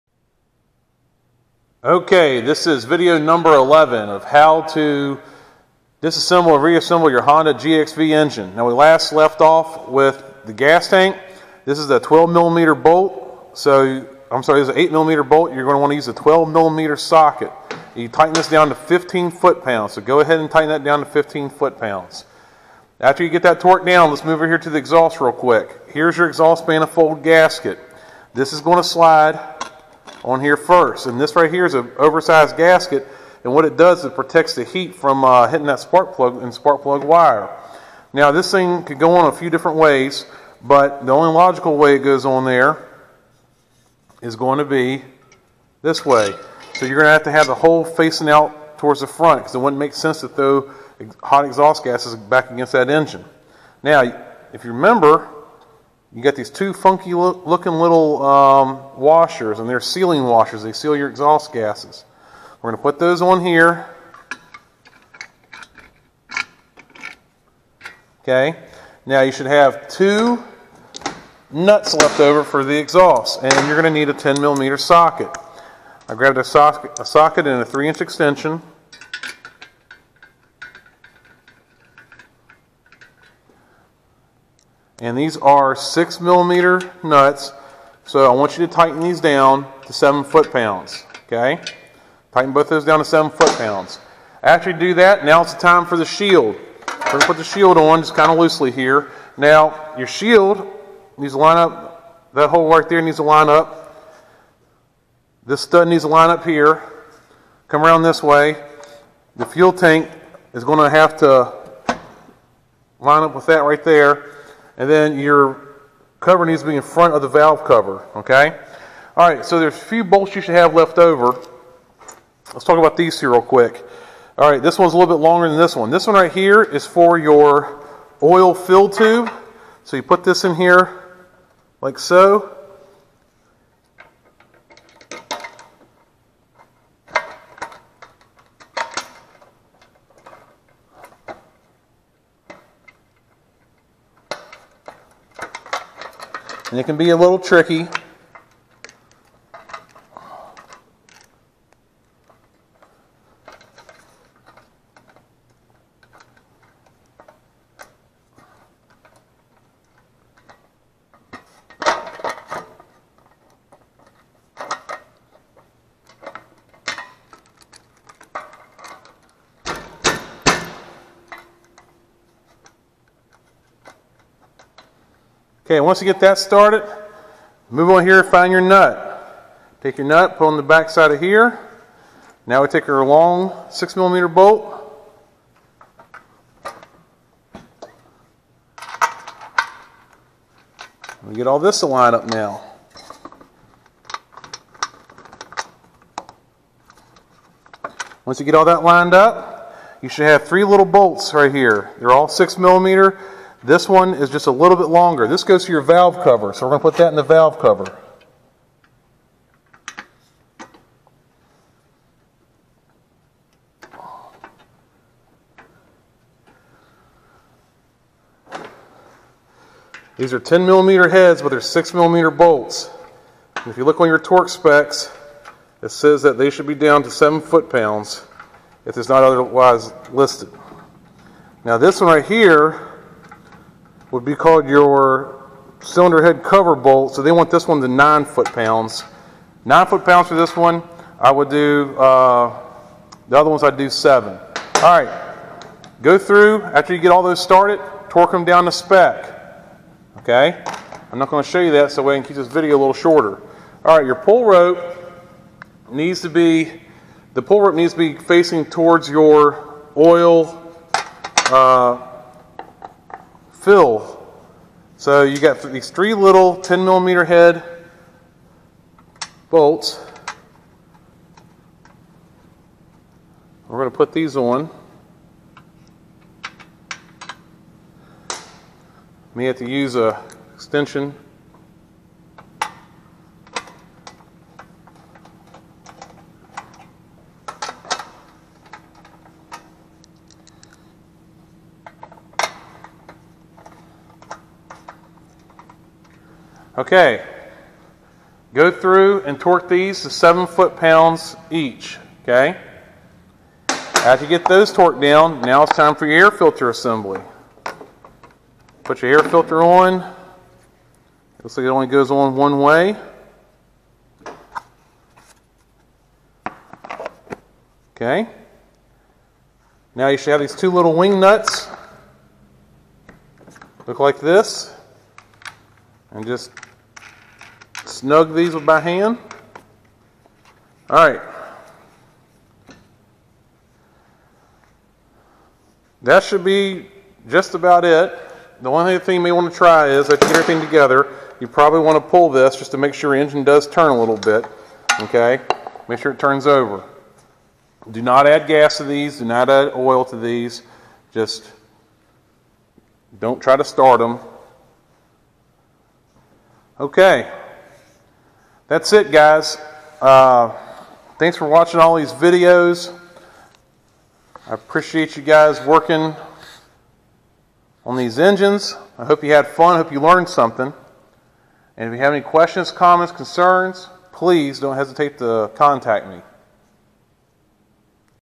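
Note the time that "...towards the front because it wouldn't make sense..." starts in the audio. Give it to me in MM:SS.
00:48.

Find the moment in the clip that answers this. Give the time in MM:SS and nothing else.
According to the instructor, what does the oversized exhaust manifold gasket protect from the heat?
00:35.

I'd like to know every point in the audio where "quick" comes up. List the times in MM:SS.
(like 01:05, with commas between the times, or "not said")
00:25, 02:03.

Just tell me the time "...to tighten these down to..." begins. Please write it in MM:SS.
01:28.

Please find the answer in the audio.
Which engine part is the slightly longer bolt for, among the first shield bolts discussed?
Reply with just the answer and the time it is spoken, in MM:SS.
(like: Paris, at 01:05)
oil fill tube, at 02:08.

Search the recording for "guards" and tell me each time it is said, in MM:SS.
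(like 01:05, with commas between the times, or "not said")
not said.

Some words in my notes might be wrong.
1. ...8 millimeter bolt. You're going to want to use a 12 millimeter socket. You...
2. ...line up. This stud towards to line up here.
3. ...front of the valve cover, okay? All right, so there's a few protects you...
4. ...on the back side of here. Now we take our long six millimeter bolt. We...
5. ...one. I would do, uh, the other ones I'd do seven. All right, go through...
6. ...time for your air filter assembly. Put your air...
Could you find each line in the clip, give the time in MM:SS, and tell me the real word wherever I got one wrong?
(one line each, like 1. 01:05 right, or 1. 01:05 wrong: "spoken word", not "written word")
1. 00:14 right
2. 01:43 wrong: "needs", not "towards"
3. 01:56 wrong: "bolts", not "protects"
4. 03:00 right
5. 04:00 right
6. 05:05 right.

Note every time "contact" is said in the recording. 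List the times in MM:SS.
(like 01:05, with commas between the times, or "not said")
06:15.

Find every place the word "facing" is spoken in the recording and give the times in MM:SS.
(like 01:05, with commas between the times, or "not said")
00:47, 04:18.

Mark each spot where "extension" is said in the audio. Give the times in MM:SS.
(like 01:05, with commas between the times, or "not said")
01:18, 04:40.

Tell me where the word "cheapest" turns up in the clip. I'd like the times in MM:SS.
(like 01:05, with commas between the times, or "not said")
not said.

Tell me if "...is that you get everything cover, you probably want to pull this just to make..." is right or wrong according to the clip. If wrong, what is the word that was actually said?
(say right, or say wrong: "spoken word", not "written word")
wrong: "together", not "cover".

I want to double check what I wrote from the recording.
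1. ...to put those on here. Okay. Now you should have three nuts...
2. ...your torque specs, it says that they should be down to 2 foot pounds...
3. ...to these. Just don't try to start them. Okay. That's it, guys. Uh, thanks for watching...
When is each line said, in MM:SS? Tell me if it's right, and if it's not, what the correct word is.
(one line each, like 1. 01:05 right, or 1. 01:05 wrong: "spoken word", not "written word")
1. 01:02 wrong: "two", not "three"
2. 03:44 wrong: "7", not "2"
3. 05:50 right.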